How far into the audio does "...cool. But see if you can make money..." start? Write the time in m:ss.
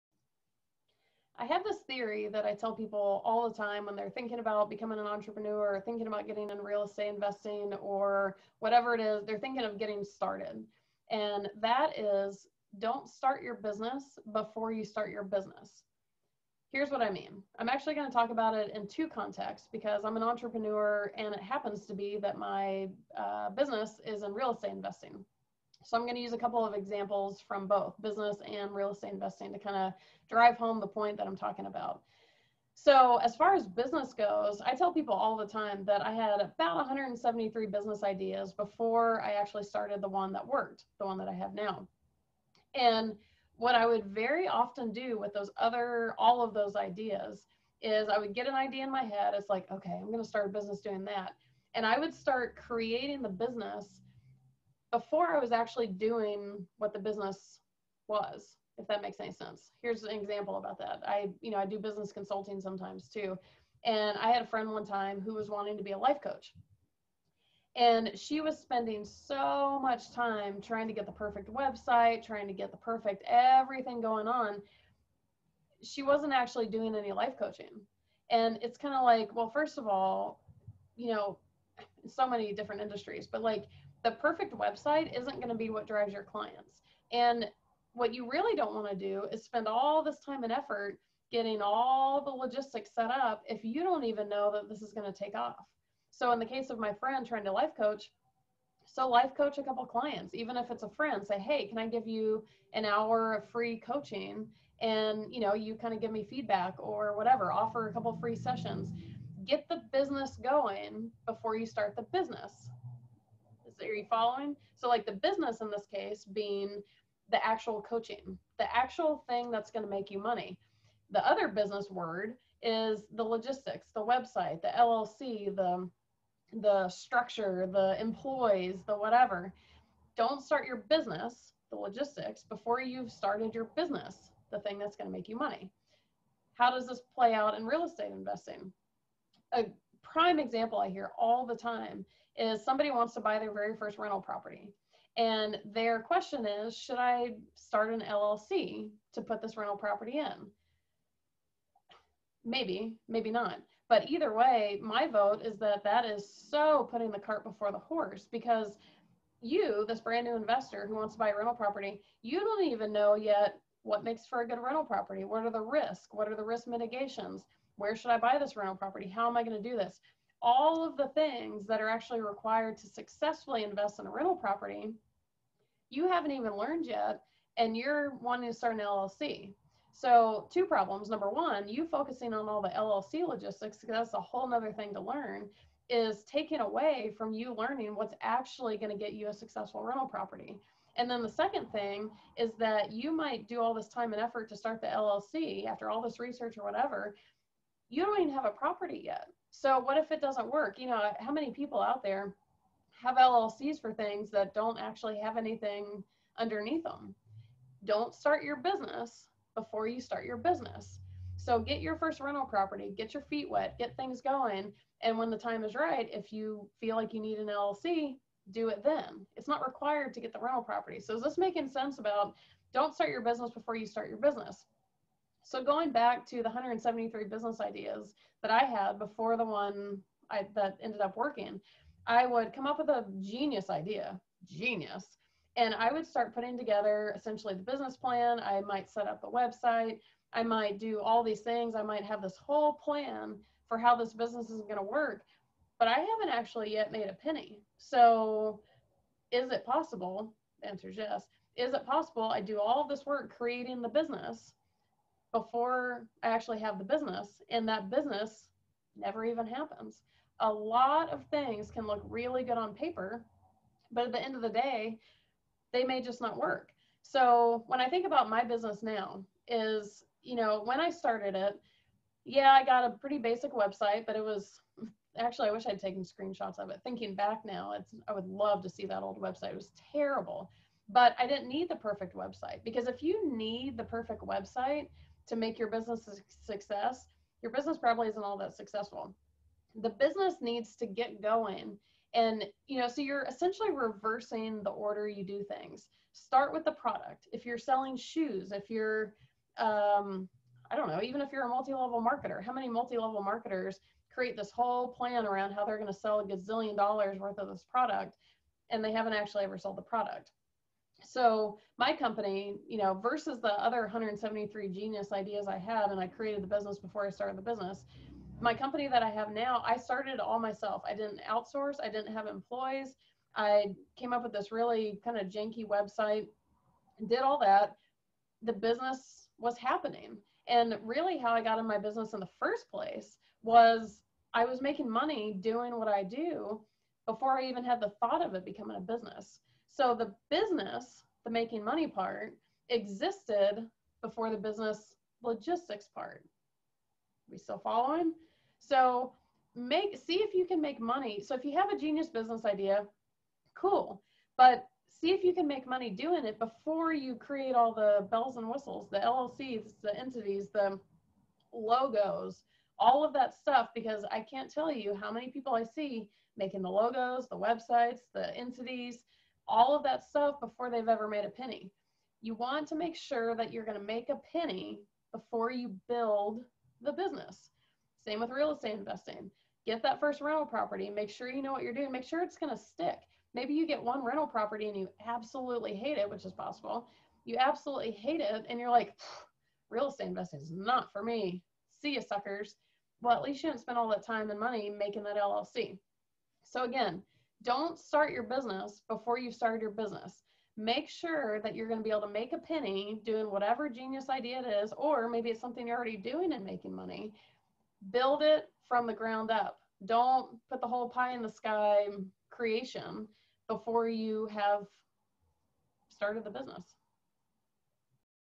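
5:53.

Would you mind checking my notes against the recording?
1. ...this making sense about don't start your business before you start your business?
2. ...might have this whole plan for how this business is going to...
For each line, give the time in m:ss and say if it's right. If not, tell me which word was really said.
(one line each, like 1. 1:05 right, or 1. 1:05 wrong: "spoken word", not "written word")
1. 3:41 right
2. 4:01 right.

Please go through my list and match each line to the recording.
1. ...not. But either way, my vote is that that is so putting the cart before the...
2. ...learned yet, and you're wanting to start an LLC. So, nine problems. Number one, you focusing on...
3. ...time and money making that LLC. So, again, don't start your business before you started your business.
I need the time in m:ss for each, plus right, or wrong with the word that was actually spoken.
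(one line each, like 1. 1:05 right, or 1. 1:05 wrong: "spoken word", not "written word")
1. 2:33 right
2. 2:56 wrong: "two", not "nine"
3. 6:34 right.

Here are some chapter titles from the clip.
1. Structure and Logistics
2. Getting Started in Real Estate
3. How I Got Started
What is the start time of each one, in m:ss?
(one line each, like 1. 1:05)
1. 2:00
2. 2:17
3. 4:30.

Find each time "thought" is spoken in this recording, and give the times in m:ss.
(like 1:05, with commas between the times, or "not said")
5:37.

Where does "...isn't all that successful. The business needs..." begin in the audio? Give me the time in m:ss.
4:48.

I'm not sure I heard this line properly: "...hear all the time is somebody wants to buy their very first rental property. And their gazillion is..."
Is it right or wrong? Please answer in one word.
wrong.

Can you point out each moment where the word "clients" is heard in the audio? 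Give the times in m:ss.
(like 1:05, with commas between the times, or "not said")
1:26, 1:39.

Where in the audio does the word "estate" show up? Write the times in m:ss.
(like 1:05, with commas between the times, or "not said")
0:06, 0:24, 0:28, 2:17, 6:18, 6:29.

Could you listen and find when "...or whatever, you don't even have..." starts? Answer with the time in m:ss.
3:16.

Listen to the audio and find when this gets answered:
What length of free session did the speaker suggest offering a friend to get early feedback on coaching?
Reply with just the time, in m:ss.
1:42.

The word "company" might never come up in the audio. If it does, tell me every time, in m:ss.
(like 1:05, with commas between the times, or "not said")
5:11, 5:18.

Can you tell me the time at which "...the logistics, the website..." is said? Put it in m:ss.
2:03.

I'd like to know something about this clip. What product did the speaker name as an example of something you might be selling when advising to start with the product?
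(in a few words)
shoes.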